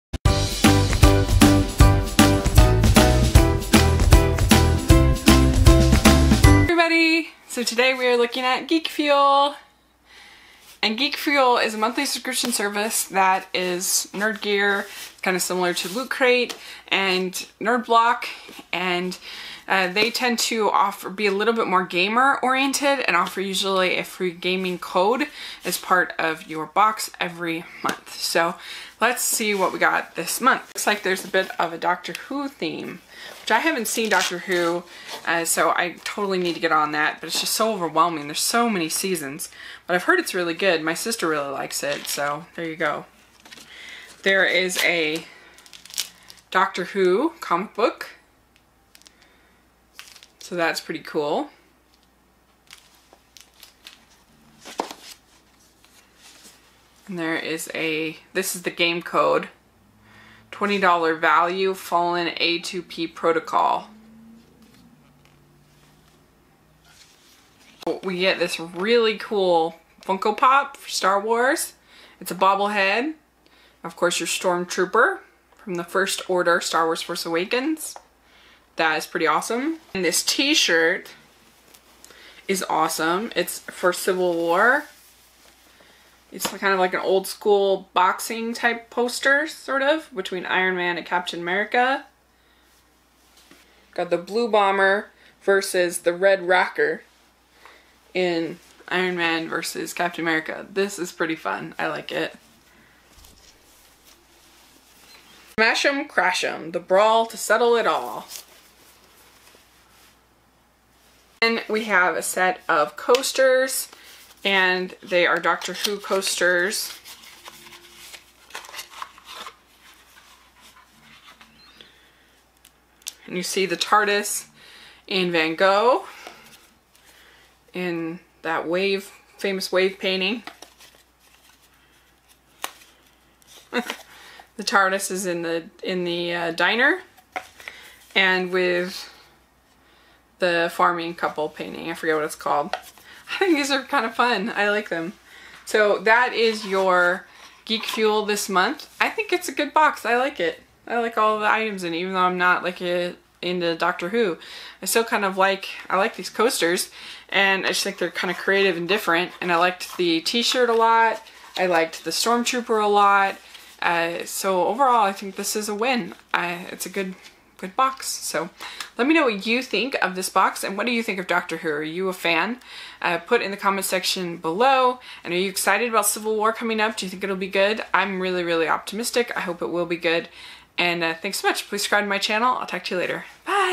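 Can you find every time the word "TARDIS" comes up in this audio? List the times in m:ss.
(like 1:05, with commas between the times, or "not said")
2:03, 2:14.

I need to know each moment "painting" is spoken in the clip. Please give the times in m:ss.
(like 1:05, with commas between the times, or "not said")
2:09, 2:21.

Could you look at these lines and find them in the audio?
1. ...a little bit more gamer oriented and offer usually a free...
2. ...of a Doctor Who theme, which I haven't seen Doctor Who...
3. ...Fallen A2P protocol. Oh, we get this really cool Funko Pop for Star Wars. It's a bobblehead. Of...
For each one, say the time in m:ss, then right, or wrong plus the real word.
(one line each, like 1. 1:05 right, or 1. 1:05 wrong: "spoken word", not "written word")
1. 0:21 right
2. 0:31 right
3. 1:01 right.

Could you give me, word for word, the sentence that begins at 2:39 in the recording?
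And I liked the t-shirt a lot.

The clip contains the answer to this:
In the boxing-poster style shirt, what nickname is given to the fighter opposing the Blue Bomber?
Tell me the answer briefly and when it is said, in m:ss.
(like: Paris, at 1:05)
Red Rocker, at 1:36.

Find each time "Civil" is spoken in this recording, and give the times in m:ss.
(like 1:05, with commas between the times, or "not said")
1:23, 2:56.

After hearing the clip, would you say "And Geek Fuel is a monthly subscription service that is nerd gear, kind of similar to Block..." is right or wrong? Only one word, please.
wrong.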